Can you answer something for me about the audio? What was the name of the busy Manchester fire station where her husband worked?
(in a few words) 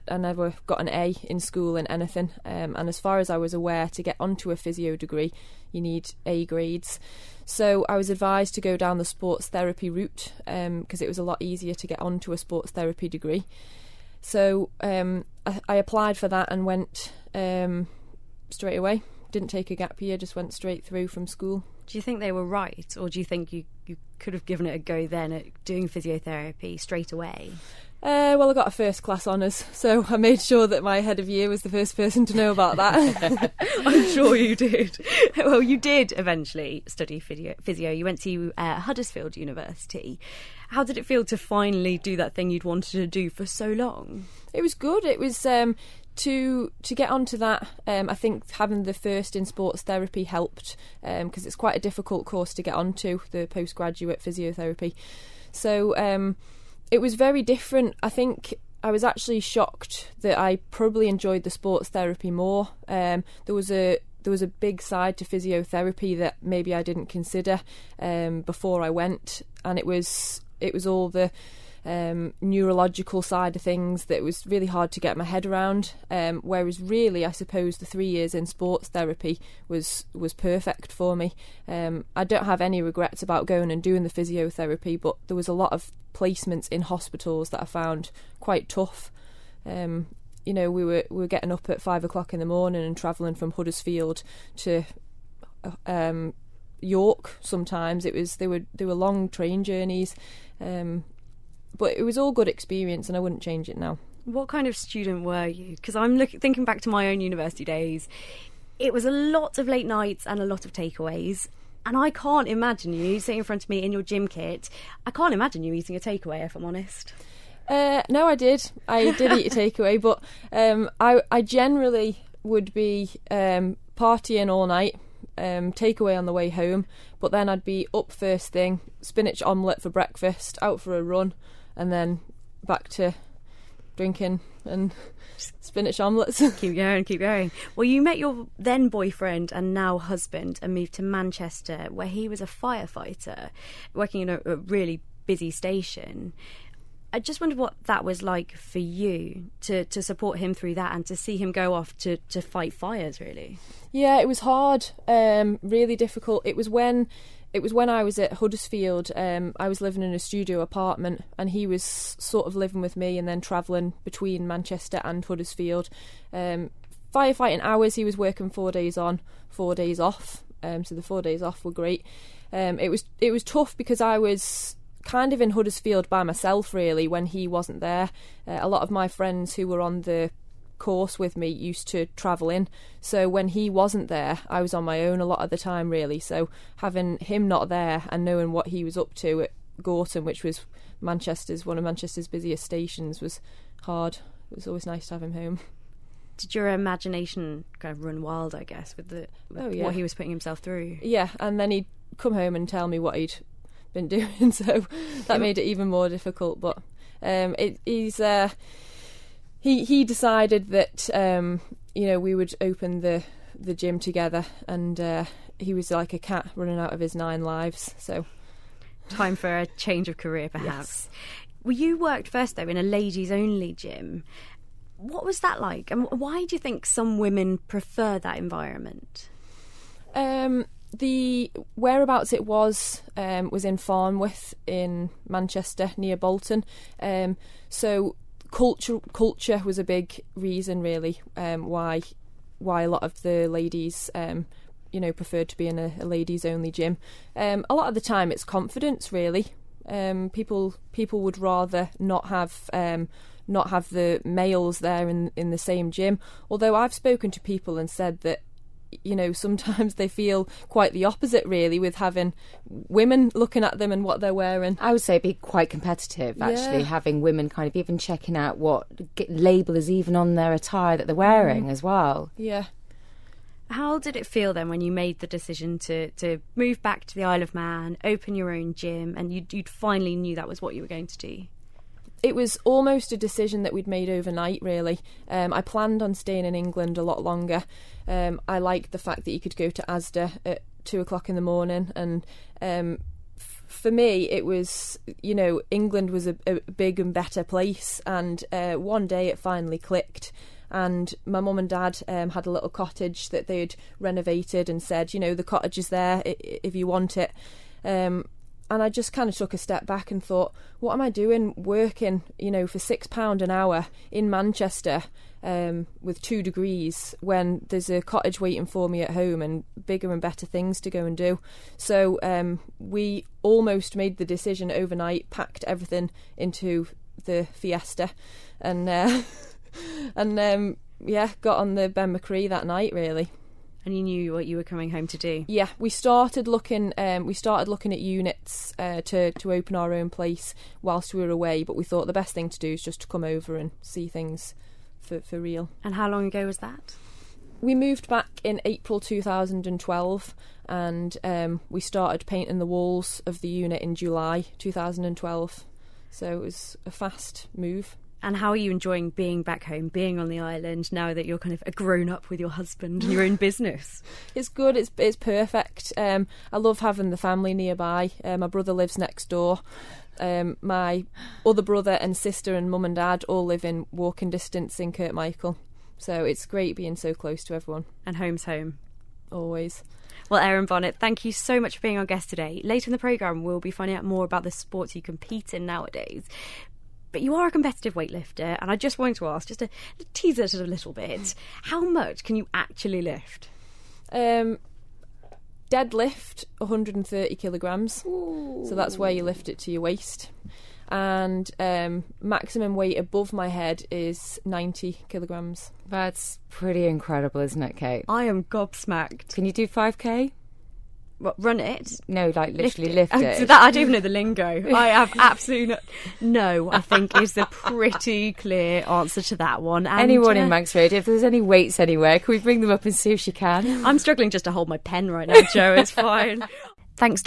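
Gorton.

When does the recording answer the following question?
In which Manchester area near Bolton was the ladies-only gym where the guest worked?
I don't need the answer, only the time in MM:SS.
03:53.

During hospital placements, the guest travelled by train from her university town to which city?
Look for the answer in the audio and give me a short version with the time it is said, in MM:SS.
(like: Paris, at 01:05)
York, at 01:36.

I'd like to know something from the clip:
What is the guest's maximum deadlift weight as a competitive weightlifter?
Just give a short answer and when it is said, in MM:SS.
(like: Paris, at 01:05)
130 kilograms, at 06:36.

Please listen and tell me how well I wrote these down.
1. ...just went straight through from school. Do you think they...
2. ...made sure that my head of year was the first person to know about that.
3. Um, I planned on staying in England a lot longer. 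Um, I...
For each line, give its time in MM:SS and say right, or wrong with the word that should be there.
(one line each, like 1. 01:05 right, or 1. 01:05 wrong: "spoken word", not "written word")
1. 00:20 right
2. 00:30 right
3. 04:45 right.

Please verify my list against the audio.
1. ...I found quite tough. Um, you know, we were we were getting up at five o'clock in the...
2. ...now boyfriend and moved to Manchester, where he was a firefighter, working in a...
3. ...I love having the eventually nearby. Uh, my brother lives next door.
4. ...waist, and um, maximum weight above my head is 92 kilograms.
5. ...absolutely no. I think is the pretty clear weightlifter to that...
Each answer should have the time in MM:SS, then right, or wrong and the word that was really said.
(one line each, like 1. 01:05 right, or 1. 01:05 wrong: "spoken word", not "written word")
1. 01:27 right
2. 02:19 wrong: "husband", not "boyfriend"
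3. 06:06 wrong: "family", not "eventually"
4. 06:39 wrong: "90", not "92"
5. 06:55 wrong: "answer", not "weightlifter".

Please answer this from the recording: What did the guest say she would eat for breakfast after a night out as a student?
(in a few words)
Spinach omelette.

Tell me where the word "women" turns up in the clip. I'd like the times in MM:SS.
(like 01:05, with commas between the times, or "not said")
03:47, 04:22, 04:27.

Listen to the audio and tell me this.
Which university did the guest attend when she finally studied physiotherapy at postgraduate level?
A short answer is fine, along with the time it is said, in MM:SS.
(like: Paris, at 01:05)
Huddersfield University, at 00:38.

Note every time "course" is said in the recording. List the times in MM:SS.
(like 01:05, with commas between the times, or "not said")
00:52, 03:00.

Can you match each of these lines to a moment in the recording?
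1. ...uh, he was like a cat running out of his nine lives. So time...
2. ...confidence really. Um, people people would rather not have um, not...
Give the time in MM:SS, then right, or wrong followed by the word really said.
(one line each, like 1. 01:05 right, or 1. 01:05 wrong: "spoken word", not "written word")
1. 03:34 right
2. 04:08 right.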